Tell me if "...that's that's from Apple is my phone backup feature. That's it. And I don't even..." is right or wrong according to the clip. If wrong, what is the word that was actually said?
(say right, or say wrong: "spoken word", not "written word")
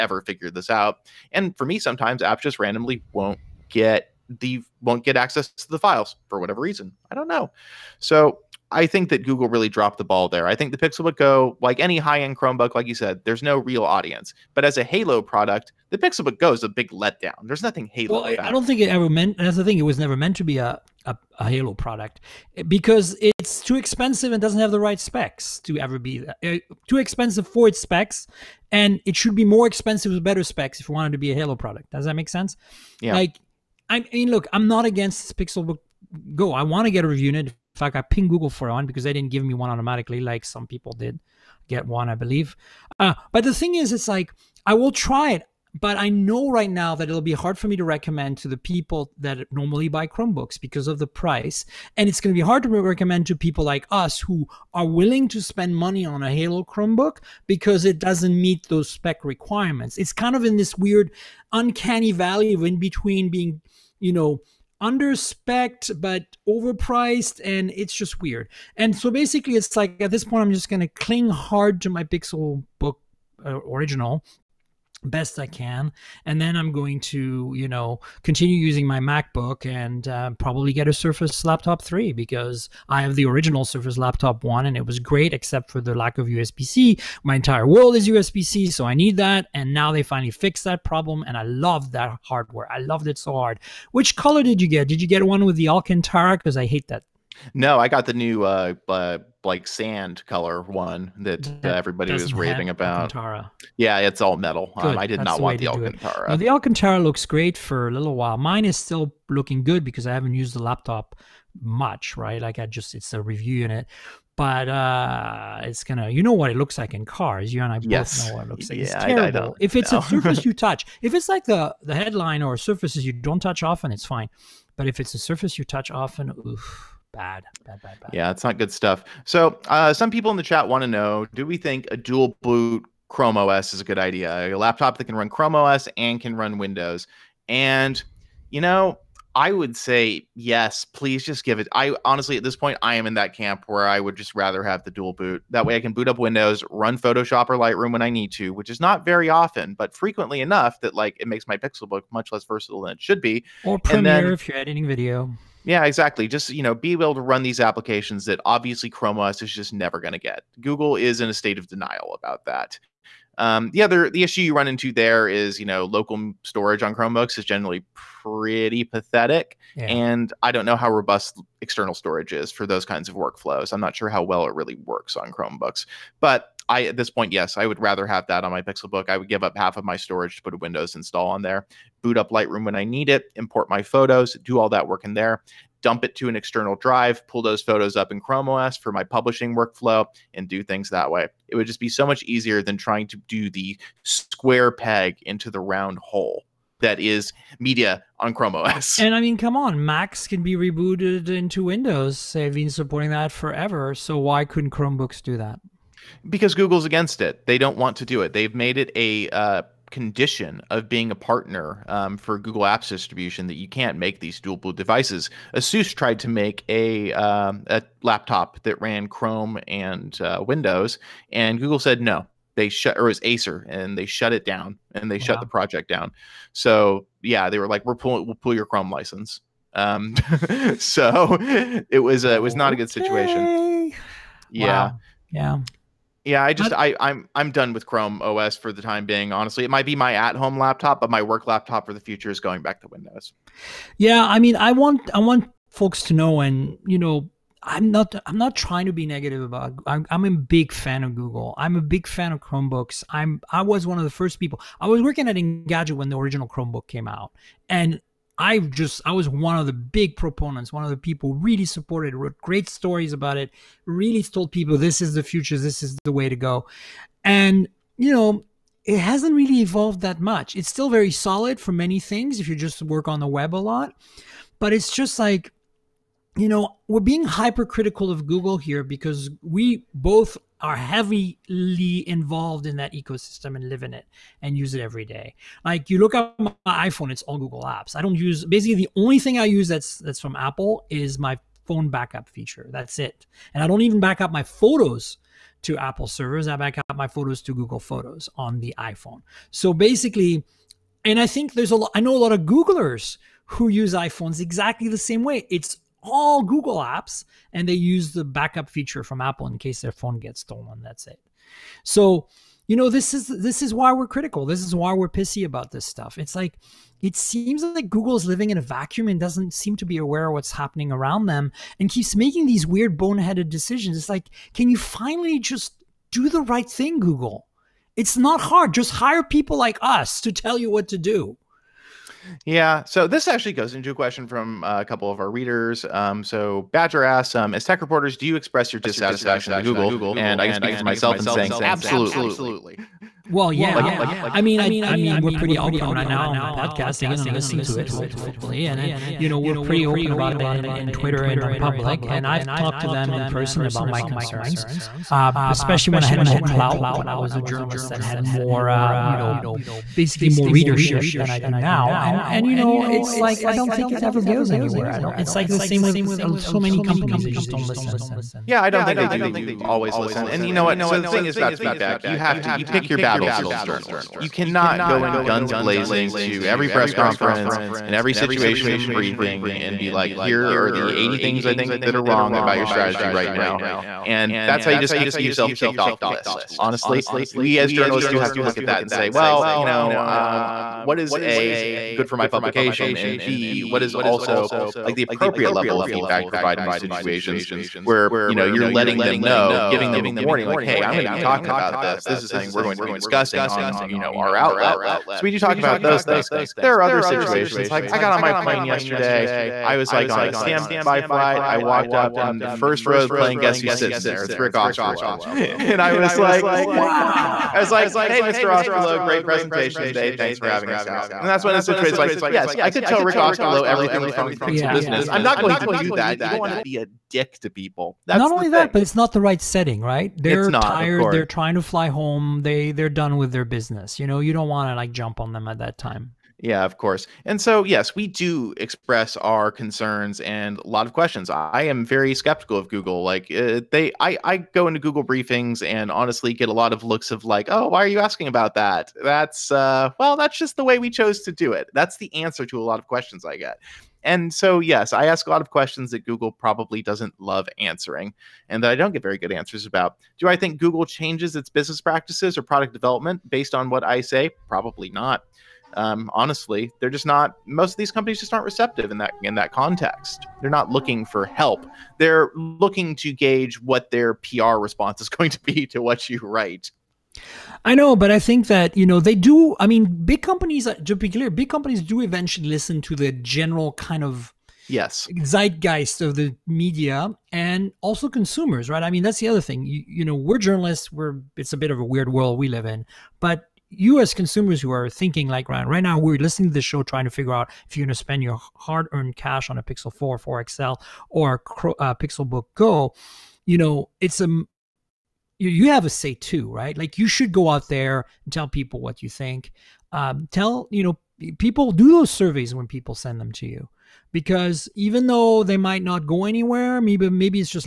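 right.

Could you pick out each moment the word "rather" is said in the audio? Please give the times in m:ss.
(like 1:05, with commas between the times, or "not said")
2:24, 2:57.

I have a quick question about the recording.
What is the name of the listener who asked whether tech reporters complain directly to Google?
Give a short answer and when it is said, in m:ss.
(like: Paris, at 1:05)
Badger, at 5:36.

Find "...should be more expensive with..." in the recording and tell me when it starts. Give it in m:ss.
0:29.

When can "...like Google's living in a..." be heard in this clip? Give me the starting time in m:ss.
5:17.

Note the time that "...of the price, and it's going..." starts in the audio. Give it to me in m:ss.
0:50.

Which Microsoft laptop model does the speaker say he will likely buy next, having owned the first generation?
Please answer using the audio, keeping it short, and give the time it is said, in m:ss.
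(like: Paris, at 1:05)
Surface Laptop 3, at 1:20.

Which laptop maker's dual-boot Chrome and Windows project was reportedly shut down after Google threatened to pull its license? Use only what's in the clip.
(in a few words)
Acer.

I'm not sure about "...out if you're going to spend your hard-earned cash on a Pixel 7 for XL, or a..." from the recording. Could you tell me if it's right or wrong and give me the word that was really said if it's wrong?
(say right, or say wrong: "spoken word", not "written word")
wrong: "4", not "7".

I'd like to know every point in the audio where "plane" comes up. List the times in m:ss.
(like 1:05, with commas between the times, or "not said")
6:48, 6:53.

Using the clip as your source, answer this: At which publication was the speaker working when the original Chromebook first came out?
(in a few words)
Engadget.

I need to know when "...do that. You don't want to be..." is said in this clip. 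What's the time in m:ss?
7:05.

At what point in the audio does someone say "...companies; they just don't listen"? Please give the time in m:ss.
6:06.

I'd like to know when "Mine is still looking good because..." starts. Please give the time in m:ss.
1:48.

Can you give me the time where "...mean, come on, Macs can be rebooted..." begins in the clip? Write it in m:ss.
3:19.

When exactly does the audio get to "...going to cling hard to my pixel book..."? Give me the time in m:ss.
1:10.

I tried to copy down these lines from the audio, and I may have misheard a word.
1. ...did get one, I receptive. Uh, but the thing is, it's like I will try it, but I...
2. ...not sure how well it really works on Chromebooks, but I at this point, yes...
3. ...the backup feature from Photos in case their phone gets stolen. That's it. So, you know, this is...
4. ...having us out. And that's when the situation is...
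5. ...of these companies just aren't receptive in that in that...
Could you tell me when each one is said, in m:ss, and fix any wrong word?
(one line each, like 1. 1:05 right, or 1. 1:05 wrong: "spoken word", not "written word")
1. 0:40 wrong: "believe", not "receptive"
2. 2:53 right
3. 5:08 wrong: "Apple", not "Photos"
4. 7:00 right
5. 7:47 right.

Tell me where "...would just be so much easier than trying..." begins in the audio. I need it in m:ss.
3:11.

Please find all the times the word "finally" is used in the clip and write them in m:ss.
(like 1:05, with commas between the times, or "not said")
1:30, 5:24.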